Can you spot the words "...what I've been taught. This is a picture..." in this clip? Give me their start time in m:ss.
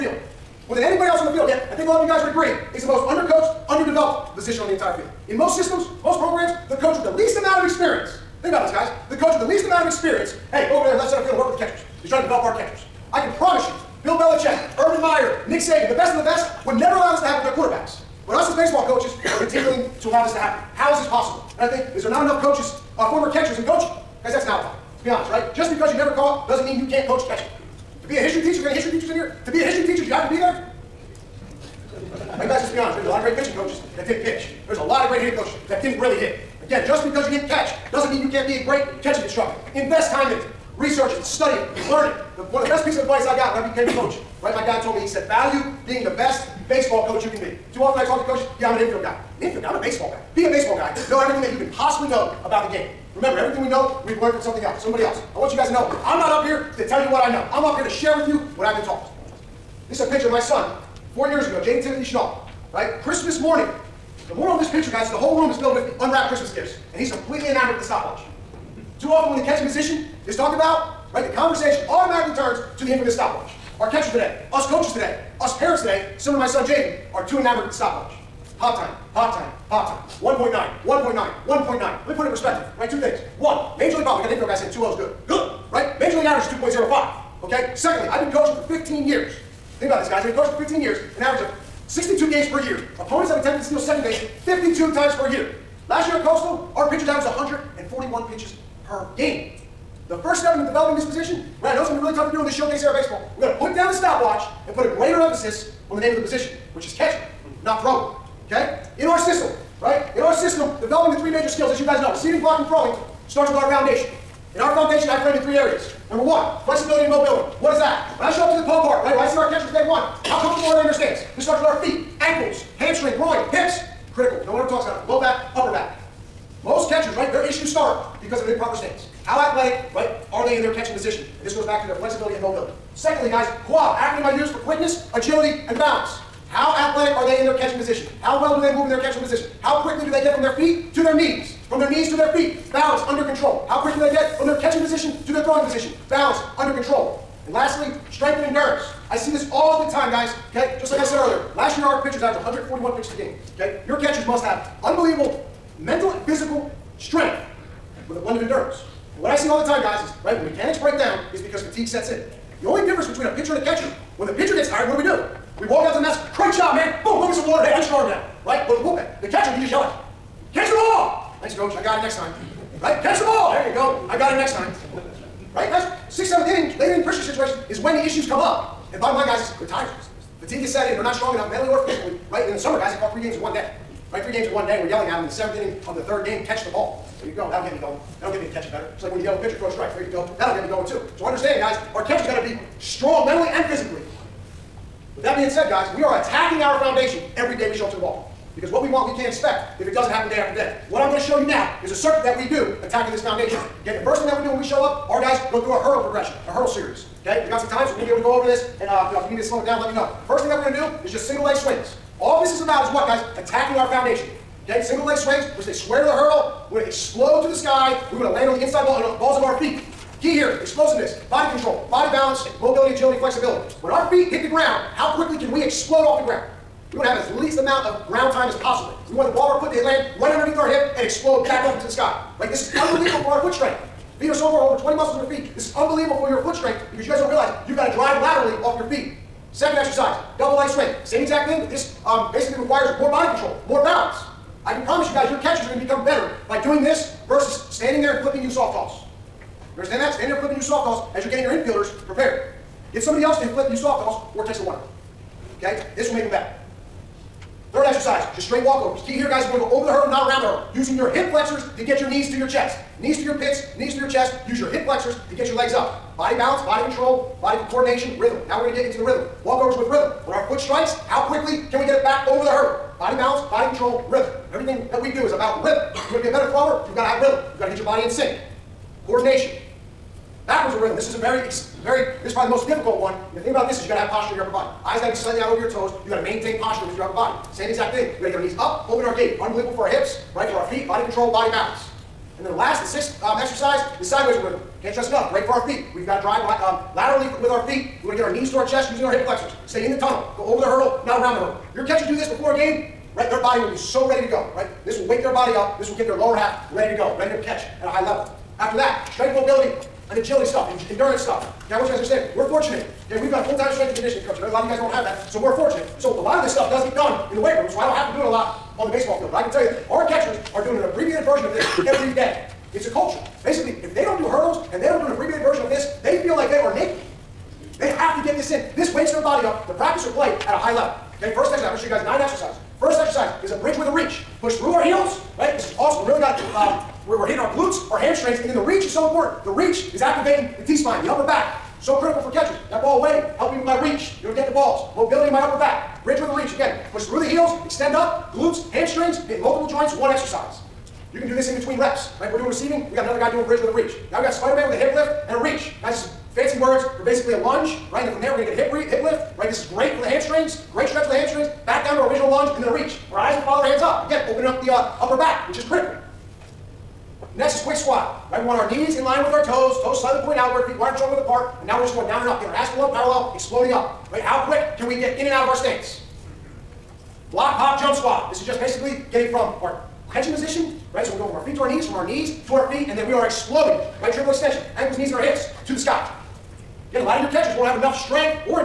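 0:58.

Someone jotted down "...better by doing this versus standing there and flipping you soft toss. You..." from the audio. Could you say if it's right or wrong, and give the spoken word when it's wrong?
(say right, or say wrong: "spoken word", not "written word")
right.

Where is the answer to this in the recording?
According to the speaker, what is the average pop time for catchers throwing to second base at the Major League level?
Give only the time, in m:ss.
1:26.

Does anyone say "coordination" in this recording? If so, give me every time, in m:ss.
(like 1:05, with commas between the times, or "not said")
4:27, 4:39.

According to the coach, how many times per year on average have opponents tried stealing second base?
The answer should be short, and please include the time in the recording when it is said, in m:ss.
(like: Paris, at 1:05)
52, at 1:34.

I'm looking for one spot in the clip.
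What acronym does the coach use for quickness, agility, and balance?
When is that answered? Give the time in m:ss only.
2:13.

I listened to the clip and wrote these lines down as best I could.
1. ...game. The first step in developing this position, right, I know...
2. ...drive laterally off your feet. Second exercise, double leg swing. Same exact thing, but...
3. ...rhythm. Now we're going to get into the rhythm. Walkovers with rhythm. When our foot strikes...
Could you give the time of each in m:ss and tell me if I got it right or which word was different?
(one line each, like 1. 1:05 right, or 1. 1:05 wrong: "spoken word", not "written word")
1. 1:39 right
2. 3:57 right
3. 4:28 right.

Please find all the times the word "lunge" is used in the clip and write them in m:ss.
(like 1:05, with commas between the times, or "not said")
5:57, 6:02.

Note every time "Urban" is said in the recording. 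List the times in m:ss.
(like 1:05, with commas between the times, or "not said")
0:14.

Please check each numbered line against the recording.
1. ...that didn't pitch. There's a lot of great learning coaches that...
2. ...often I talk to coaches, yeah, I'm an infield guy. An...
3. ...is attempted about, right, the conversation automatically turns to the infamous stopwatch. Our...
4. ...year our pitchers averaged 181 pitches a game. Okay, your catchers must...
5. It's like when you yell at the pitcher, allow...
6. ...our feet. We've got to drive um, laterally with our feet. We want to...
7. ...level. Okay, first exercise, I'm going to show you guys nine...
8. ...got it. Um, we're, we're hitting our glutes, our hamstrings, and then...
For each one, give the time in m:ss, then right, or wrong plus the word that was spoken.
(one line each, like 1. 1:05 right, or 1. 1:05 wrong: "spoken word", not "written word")
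1. 0:33 wrong: "hitting", not "learning"
2. 0:47 right
3. 1:10 wrong: "talked", not "attempted"
4. 2:31 wrong: "141", not "181"
5. 3:08 wrong: "throw", not "allow"
6. 4:55 right
7. 5:30 right
8. 5:36 right.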